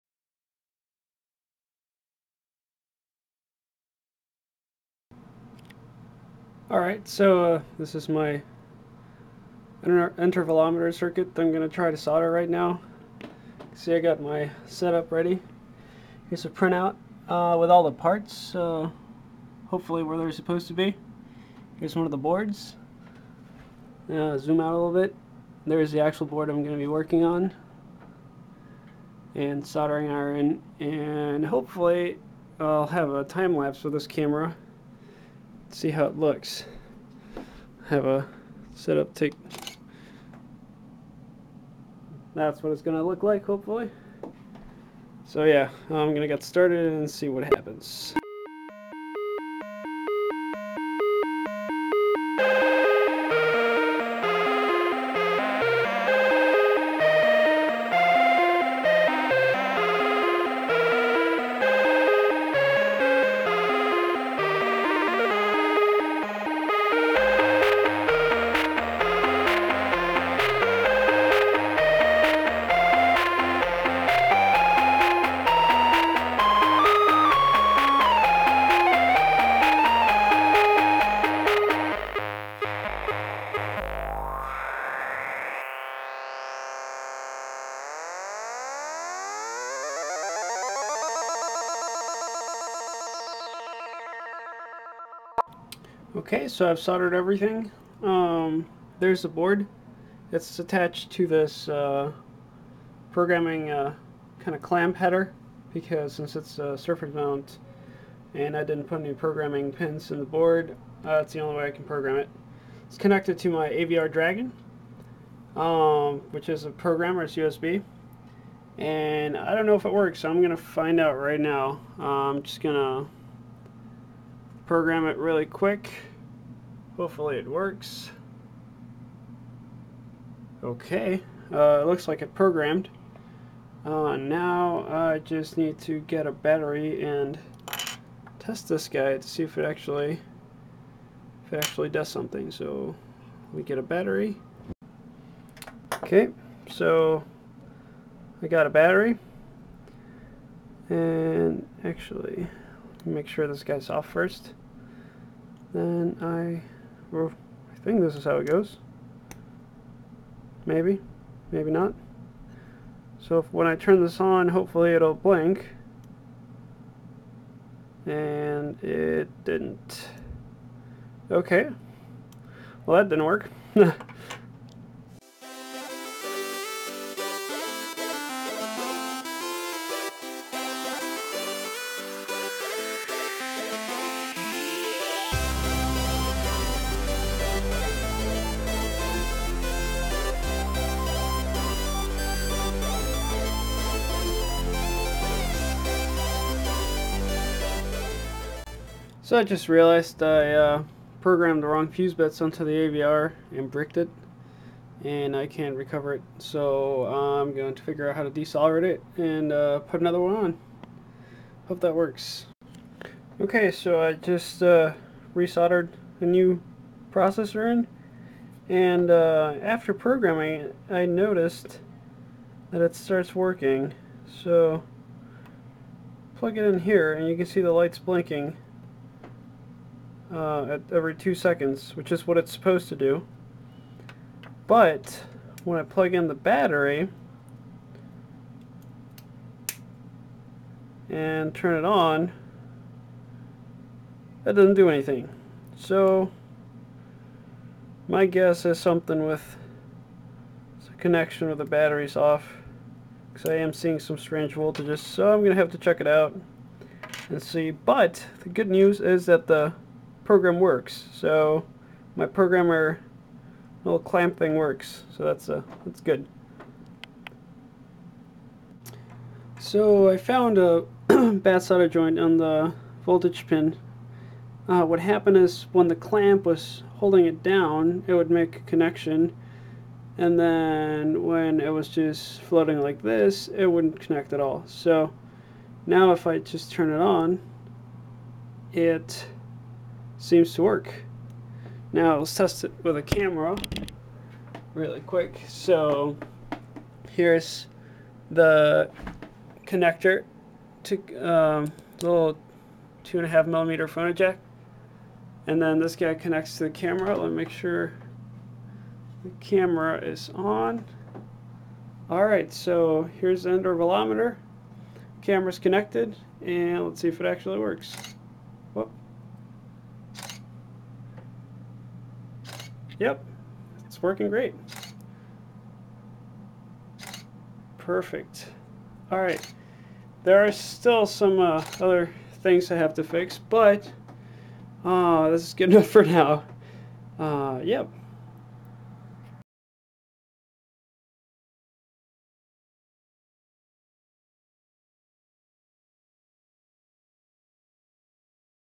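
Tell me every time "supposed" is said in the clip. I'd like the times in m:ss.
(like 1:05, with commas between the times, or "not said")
0:20, 3:52.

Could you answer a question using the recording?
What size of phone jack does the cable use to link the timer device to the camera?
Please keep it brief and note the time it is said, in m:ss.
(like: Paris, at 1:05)
2.5 millimeter, at 5:03.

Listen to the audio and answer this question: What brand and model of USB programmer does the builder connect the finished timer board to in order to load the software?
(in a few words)
AVR Dragon.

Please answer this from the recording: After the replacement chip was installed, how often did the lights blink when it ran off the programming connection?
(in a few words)
every 2 seconds.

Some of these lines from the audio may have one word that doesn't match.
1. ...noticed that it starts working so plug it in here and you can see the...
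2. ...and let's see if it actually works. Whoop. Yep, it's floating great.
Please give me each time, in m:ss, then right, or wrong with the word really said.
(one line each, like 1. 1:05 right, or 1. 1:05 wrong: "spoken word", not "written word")
1. 3:41 right
2. 5:16 wrong: "working", not "floating".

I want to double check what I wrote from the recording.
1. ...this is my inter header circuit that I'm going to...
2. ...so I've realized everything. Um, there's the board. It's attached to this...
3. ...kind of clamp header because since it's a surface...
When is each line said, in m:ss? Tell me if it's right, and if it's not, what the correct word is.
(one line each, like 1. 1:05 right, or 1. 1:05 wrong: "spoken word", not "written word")
1. 0:07 wrong: "intervalometer", not "header"
2. 1:36 wrong: "soldered", not "realized"
3. 1:44 right.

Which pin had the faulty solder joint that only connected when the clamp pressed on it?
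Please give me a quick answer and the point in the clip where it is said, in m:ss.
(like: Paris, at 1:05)
voltage pin, at 4:33.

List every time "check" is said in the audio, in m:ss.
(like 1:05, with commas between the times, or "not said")
4:15.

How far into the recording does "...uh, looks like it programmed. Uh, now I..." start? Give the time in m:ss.
2:11.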